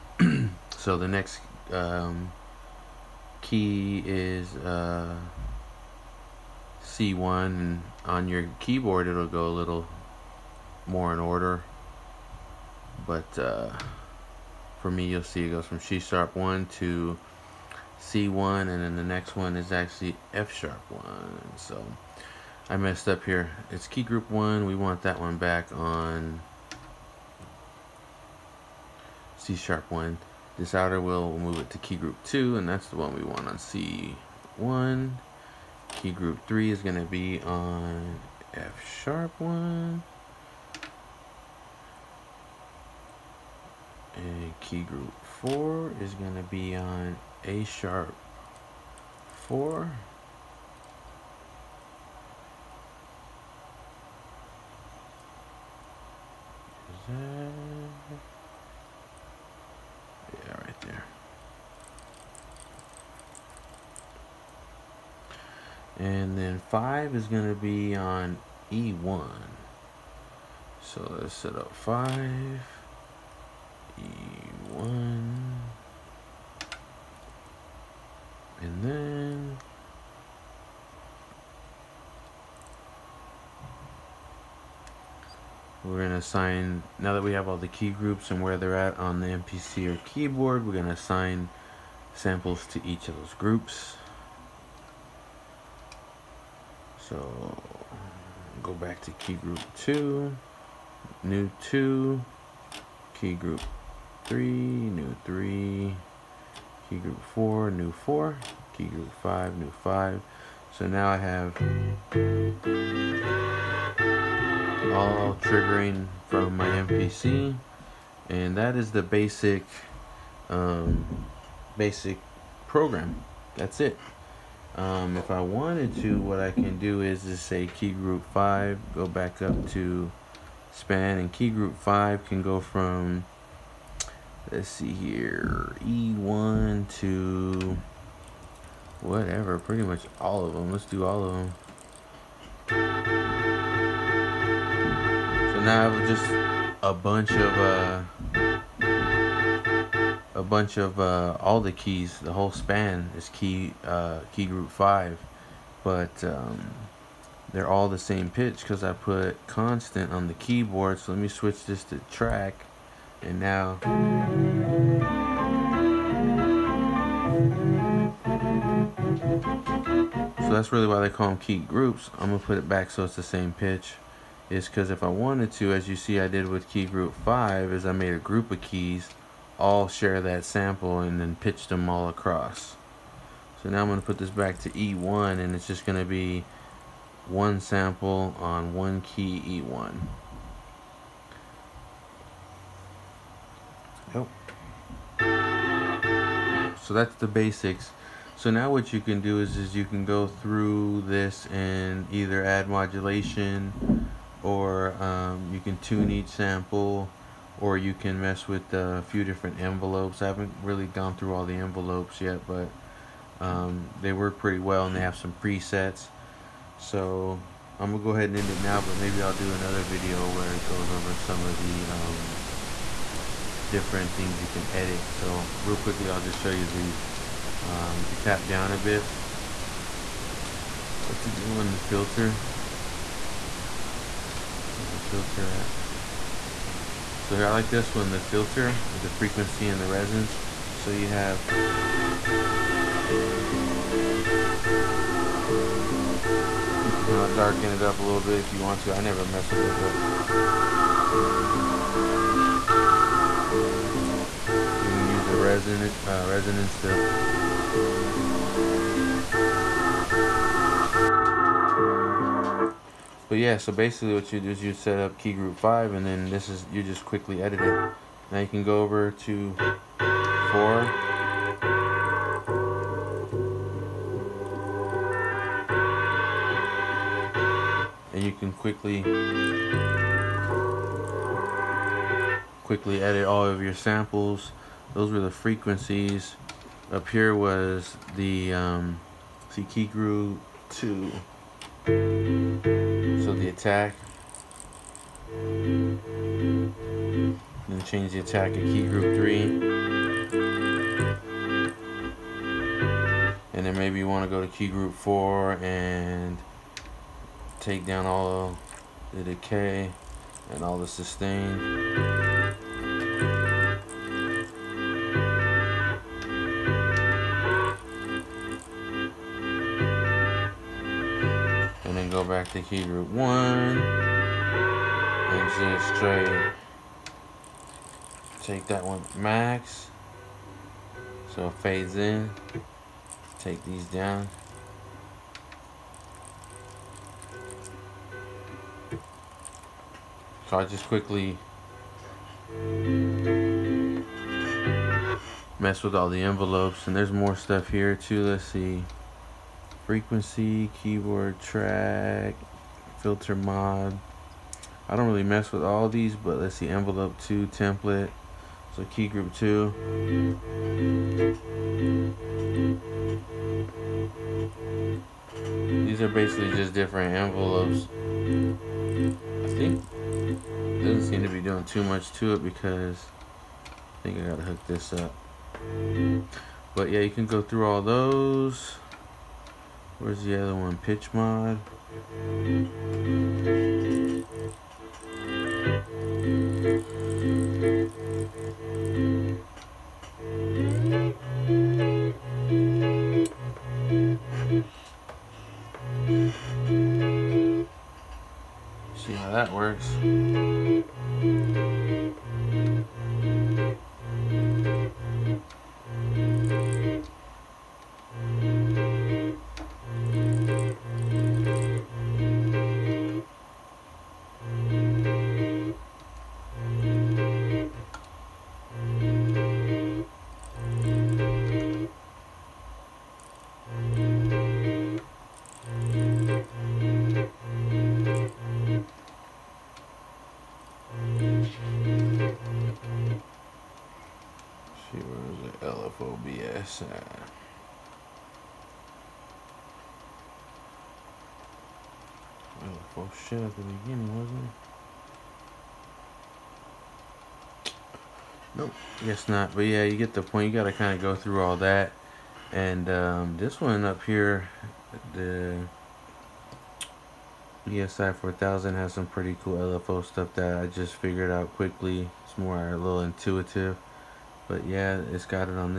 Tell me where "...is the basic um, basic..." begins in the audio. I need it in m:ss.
1:58.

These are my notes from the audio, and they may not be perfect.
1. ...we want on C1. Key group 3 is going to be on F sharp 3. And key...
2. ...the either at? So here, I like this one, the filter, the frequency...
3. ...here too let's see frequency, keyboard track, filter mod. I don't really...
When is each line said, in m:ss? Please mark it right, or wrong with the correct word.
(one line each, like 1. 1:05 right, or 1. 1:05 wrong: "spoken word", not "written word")
1. 0:33 wrong: "1", not "3"
2. 3:54 wrong: "filter", not "either"
3. 5:47 right.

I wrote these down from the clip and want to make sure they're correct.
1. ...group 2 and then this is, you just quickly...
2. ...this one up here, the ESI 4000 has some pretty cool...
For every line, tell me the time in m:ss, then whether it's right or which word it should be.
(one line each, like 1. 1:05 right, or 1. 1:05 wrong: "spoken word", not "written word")
1. 4:25 wrong: "5", not "2"
2. 7:33 right.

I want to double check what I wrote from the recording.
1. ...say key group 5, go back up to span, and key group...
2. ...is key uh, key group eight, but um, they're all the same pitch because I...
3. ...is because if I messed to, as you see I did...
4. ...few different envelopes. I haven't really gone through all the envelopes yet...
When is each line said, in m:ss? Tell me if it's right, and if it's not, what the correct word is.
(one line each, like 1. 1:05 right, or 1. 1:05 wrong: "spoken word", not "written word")
1. 2:07 right
2. 2:33 wrong: "five", not "eight"
3. 2:54 wrong: "wanted", not "messed"
4. 3:29 right.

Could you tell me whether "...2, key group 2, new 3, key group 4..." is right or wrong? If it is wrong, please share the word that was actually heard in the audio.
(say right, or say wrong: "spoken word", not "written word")
wrong: "3", not "2".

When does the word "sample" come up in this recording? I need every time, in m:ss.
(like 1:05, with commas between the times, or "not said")
1:32, 3:00, 3:07, 3:26, 4:43.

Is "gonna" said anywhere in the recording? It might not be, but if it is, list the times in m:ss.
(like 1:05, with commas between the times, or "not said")
2:52, 3:37.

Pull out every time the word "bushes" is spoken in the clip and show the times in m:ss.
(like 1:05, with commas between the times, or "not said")
not said.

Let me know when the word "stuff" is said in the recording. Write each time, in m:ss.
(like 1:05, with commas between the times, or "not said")
5:47, 7:40.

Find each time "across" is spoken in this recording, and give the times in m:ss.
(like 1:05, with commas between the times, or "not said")
3:02.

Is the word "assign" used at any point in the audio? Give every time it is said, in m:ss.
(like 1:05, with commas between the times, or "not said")
1:26, 1:30.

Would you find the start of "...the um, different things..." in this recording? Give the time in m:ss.
3:41.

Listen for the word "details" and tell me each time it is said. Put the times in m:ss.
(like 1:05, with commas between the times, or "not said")
not said.